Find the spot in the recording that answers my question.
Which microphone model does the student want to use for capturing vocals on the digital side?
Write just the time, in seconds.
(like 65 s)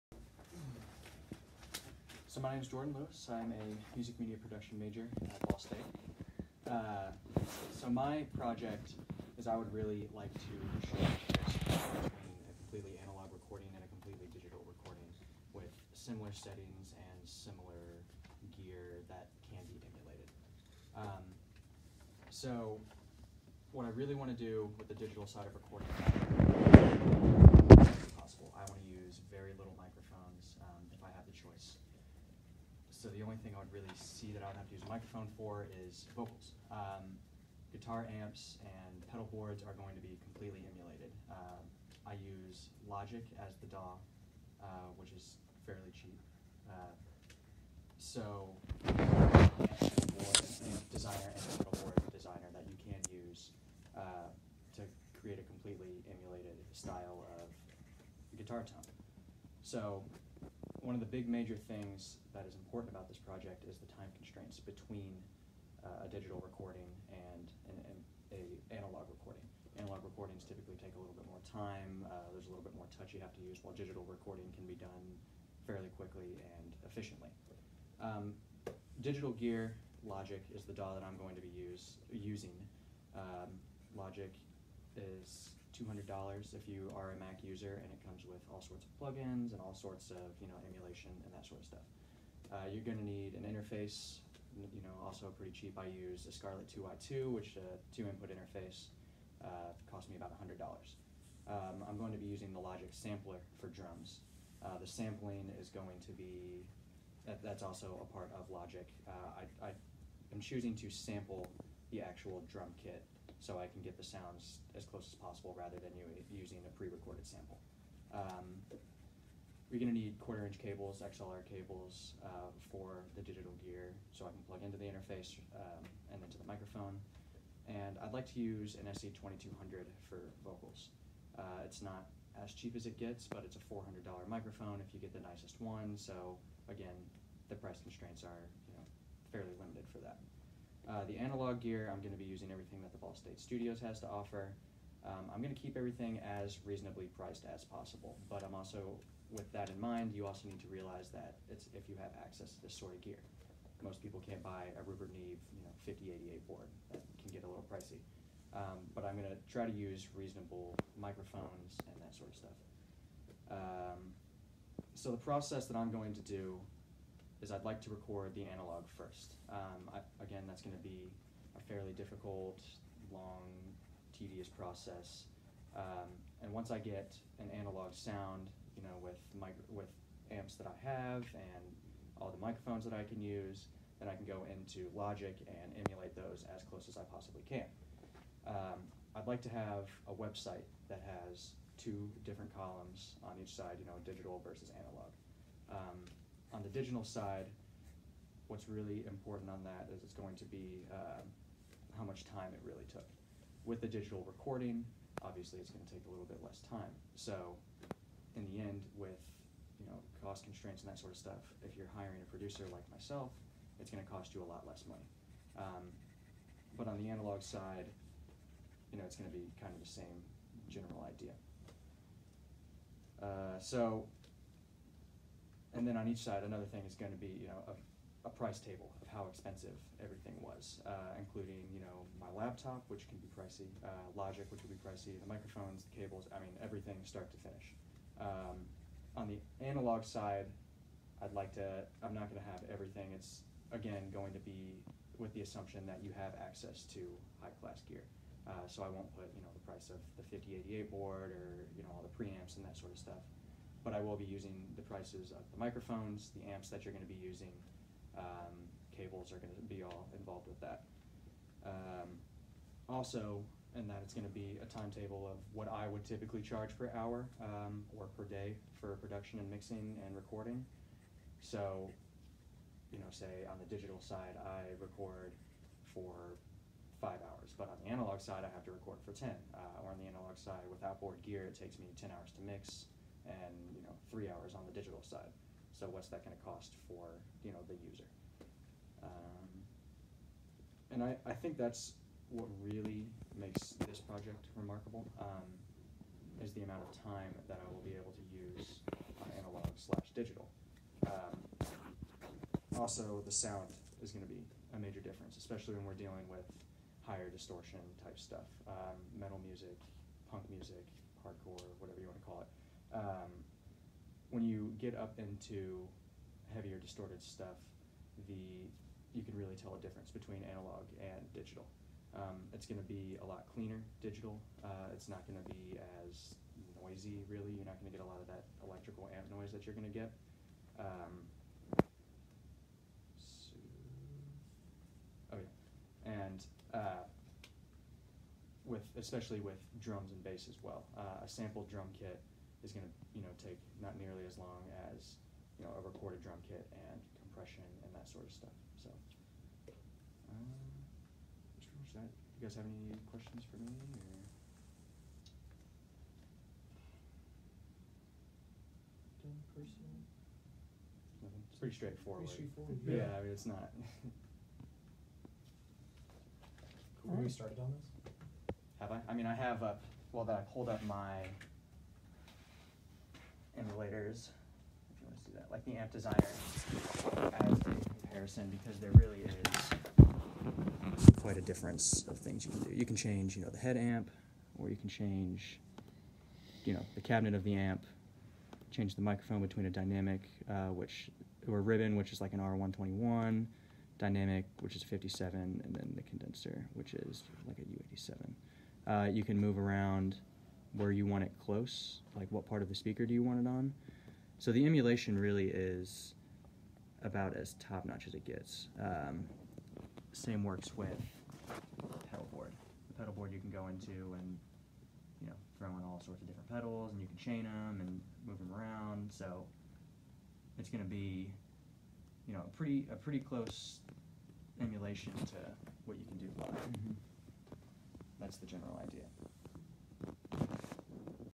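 128 s.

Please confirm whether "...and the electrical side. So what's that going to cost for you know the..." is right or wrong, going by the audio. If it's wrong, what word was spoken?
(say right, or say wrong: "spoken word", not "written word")
wrong: "digital", not "electrical".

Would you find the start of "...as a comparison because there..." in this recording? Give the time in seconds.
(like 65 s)
376 s.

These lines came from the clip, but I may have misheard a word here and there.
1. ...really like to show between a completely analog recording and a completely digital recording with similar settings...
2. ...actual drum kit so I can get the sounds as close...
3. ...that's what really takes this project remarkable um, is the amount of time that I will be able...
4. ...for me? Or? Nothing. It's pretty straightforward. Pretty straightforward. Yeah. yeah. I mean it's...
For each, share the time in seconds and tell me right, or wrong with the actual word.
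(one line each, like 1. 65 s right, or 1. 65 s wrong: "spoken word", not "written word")
1. 9 s right
2. 112 s right
3. 291 s wrong: "makes", not "takes"
4. 353 s right.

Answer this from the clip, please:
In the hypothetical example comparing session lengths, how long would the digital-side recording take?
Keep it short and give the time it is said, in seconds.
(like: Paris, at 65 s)
5 hours, at 276 s.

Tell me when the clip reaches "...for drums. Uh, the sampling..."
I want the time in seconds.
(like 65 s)
103 s.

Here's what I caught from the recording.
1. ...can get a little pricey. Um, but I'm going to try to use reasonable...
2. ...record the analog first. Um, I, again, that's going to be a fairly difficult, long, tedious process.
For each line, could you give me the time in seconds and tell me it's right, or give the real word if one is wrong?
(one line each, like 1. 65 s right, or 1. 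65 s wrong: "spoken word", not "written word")
1. 157 s right
2. 167 s right.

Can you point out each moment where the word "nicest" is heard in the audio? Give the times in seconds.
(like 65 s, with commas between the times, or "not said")
135 s.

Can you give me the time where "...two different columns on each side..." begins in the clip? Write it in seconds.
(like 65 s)
191 s.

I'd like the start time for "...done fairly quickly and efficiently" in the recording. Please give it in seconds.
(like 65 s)
74 s.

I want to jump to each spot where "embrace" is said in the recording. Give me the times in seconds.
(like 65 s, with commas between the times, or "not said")
not said.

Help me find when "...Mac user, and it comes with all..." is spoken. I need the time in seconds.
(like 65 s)
87 s.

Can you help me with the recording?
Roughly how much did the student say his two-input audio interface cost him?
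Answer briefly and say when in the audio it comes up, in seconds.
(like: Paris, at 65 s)
$100, at 100 s.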